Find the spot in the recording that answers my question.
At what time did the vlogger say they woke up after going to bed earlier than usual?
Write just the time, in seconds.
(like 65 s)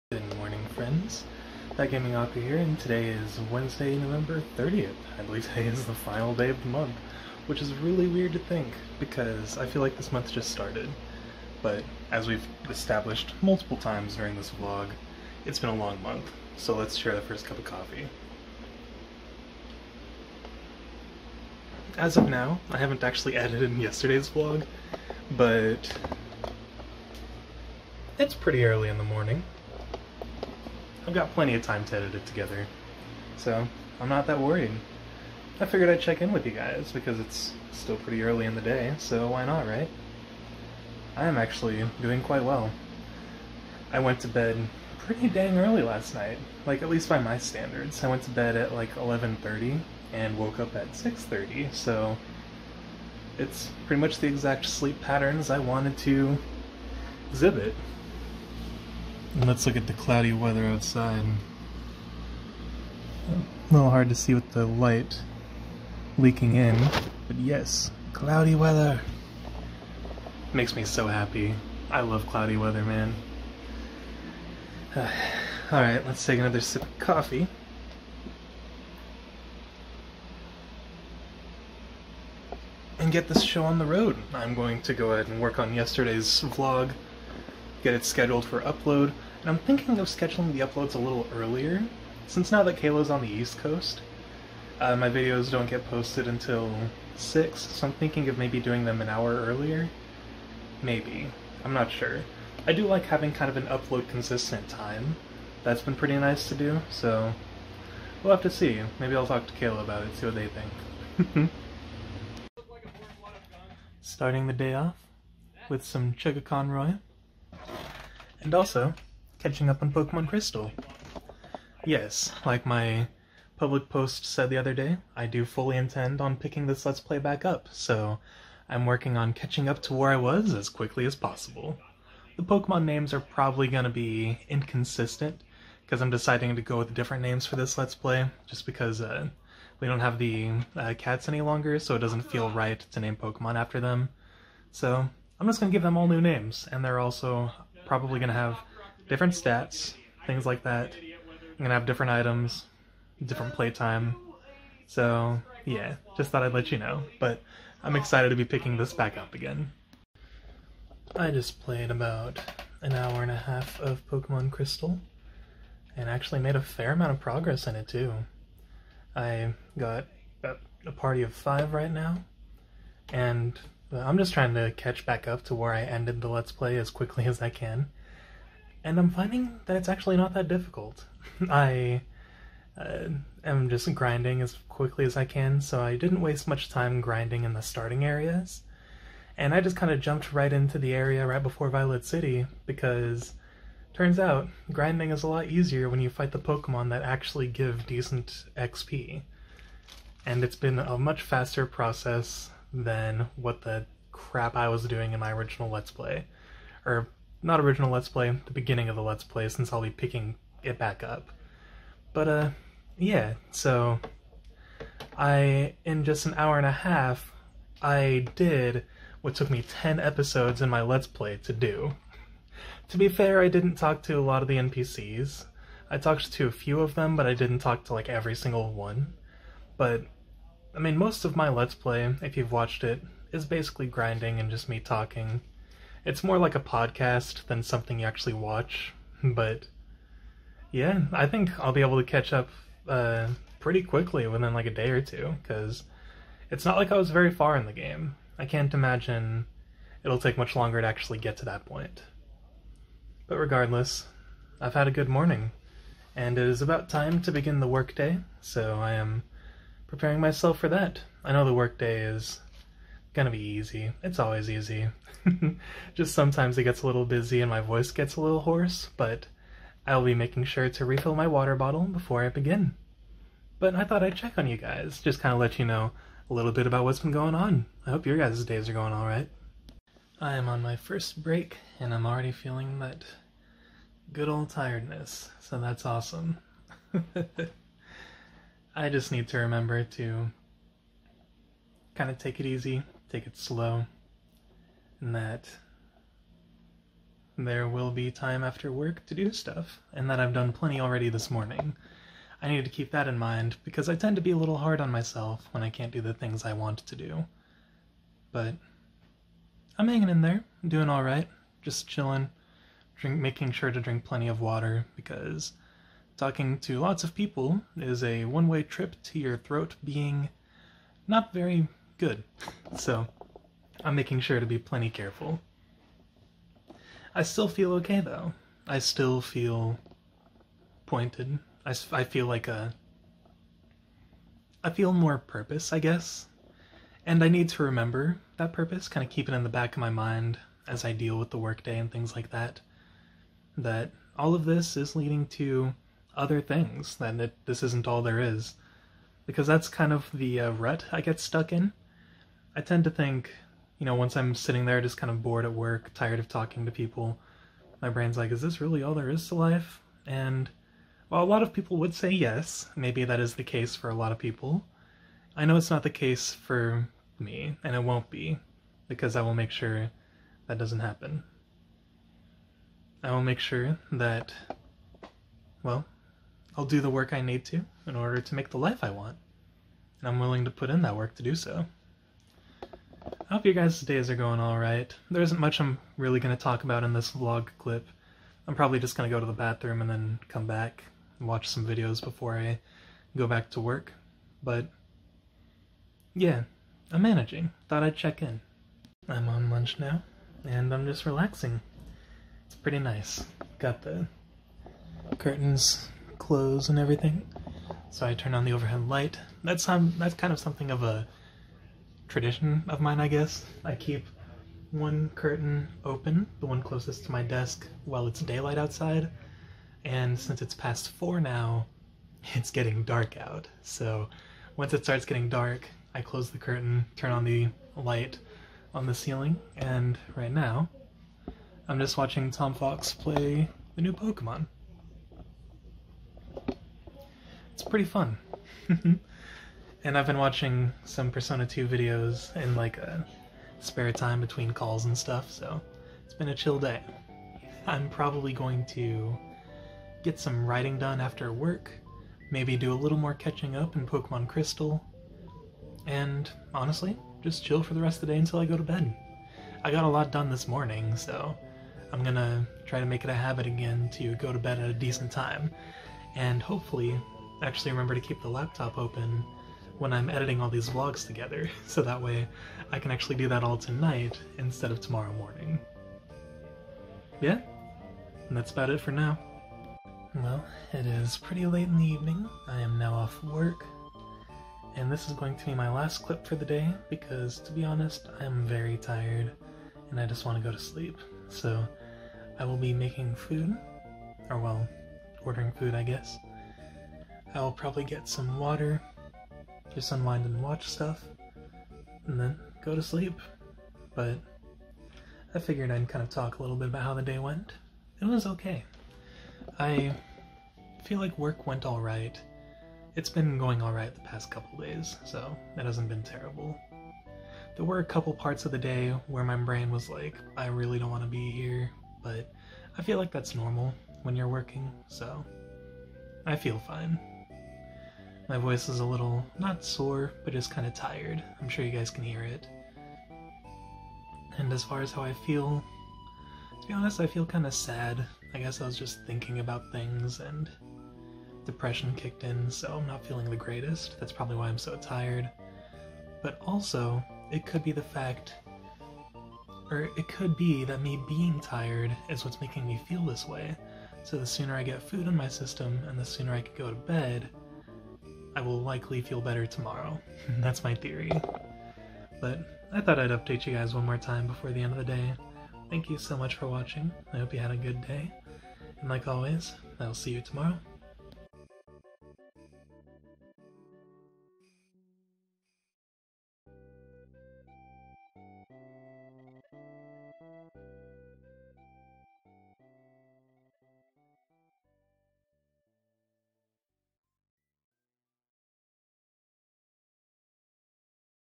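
50 s.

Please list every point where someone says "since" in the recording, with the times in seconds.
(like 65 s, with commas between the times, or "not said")
92 s, 209 s, 420 s.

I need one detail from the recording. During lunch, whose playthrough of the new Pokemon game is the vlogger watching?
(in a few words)
TomFawkes.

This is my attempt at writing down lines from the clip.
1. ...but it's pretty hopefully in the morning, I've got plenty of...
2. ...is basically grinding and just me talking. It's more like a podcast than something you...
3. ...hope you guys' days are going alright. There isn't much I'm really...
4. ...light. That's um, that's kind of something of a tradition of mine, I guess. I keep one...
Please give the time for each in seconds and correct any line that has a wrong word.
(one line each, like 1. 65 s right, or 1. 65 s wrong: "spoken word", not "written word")
1. 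25 s wrong: "early", not "hopefully"
2. 233 s right
3. 383 s right
4. 408 s right.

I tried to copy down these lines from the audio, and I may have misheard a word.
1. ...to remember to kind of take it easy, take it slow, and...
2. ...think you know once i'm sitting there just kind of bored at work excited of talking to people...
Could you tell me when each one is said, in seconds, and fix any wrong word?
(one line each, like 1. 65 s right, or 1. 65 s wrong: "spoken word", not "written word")
1. 289 s right
2. 352 s wrong: "tired", not "excited".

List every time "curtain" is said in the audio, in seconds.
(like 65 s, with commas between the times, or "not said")
405 s, 415 s, 426 s.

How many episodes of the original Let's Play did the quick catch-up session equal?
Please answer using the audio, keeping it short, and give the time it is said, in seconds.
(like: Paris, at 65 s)
10, at 219 s.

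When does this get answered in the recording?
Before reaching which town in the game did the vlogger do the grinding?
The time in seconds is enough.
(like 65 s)
191 s.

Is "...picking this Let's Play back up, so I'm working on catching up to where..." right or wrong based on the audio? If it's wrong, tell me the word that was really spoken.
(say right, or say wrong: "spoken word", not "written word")
right.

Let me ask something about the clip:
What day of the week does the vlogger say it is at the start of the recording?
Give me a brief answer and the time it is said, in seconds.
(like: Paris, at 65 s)
Wednesday, at 3 s.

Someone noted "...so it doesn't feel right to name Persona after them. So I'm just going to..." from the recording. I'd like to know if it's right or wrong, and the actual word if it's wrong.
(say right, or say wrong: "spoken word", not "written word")
wrong: "Pokemon", not "Persona".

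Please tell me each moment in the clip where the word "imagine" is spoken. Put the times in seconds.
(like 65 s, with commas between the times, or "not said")
248 s.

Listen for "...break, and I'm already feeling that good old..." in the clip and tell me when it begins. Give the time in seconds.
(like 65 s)
281 s.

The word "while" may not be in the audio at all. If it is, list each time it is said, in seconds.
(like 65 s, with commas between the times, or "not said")
361 s, 417 s.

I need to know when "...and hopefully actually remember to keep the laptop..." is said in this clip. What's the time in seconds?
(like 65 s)
466 s.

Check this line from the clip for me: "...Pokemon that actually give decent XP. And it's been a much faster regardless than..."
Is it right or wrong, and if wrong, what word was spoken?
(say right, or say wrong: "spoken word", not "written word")
wrong: "process", not "regardless".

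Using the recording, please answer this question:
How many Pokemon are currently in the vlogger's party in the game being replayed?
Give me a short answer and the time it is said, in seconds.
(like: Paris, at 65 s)
5, at 171 s.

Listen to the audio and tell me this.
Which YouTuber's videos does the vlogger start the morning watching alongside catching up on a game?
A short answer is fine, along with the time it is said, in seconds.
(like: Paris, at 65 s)
ChuggaaConroy, at 116 s.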